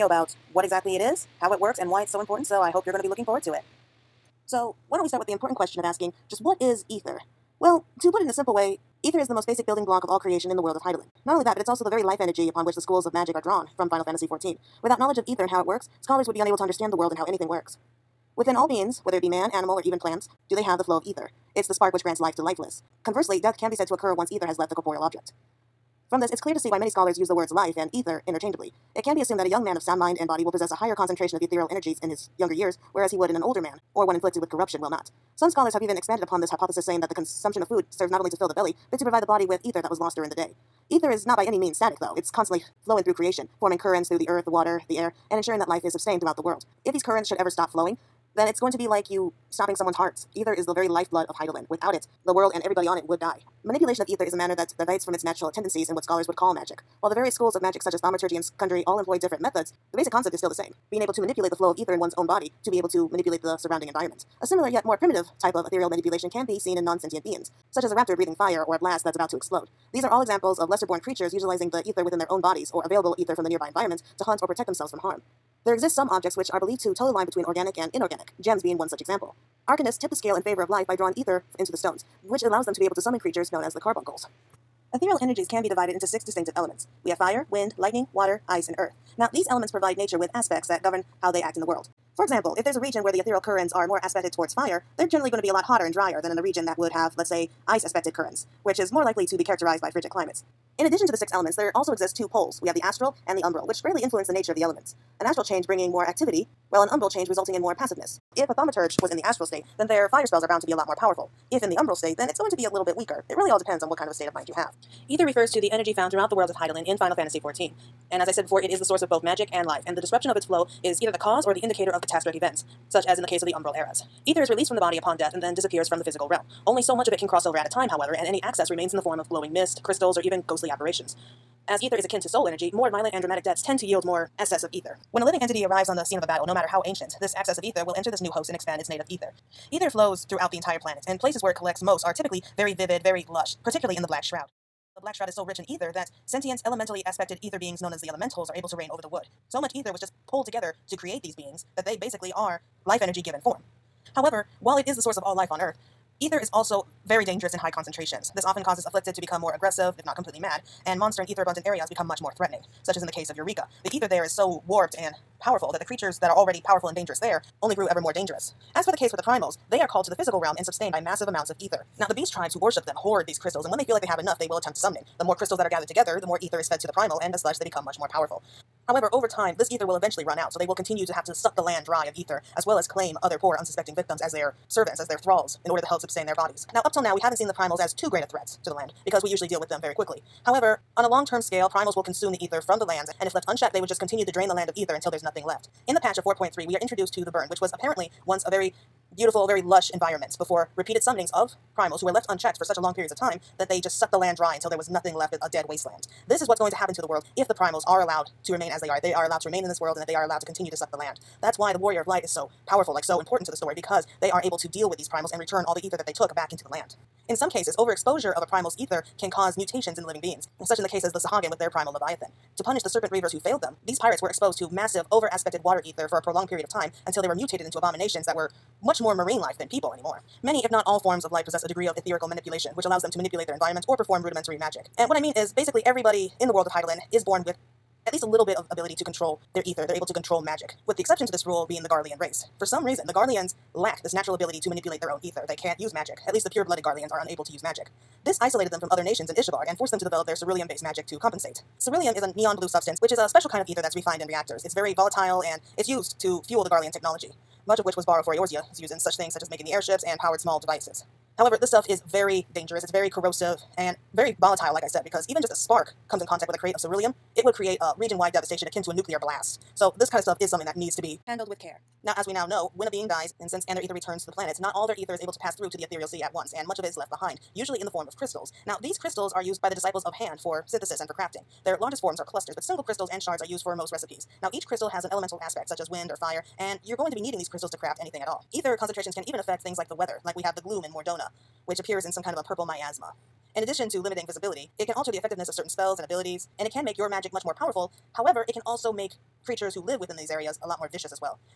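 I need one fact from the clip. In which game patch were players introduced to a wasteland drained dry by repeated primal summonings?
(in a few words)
4.3.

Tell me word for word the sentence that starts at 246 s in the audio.
At least the pure-blooded Garleans are unable to use magic.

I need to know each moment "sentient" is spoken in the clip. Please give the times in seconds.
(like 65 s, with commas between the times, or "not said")
66 s, 146 s.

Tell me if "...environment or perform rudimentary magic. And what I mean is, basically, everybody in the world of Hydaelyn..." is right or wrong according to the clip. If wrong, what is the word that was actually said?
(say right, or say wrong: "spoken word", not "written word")
right.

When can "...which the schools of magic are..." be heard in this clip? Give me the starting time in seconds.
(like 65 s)
12 s.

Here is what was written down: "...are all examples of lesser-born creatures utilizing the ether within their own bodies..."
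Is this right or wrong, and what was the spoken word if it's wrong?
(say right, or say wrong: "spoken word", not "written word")
right.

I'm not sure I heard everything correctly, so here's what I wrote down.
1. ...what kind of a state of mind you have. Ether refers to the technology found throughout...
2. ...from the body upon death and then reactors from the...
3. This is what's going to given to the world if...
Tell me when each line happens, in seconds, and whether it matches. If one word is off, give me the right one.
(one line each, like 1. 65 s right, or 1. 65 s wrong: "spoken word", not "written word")
1. 113 s wrong: "energy", not "technology"
2. 124 s wrong: "disappears", not "reactors"
3. 206 s wrong: "happen", not "given".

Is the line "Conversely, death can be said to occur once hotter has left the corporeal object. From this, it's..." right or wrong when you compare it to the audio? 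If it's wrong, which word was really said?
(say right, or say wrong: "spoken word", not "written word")
wrong: "ether", not "hotter".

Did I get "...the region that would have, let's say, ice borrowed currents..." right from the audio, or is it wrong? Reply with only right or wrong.
wrong.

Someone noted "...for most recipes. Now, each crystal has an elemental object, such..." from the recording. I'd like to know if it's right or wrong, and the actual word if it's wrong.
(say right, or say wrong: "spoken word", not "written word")
wrong: "aspect", not "object".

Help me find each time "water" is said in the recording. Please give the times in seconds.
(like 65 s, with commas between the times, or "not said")
44 s, 88 s, 225 s.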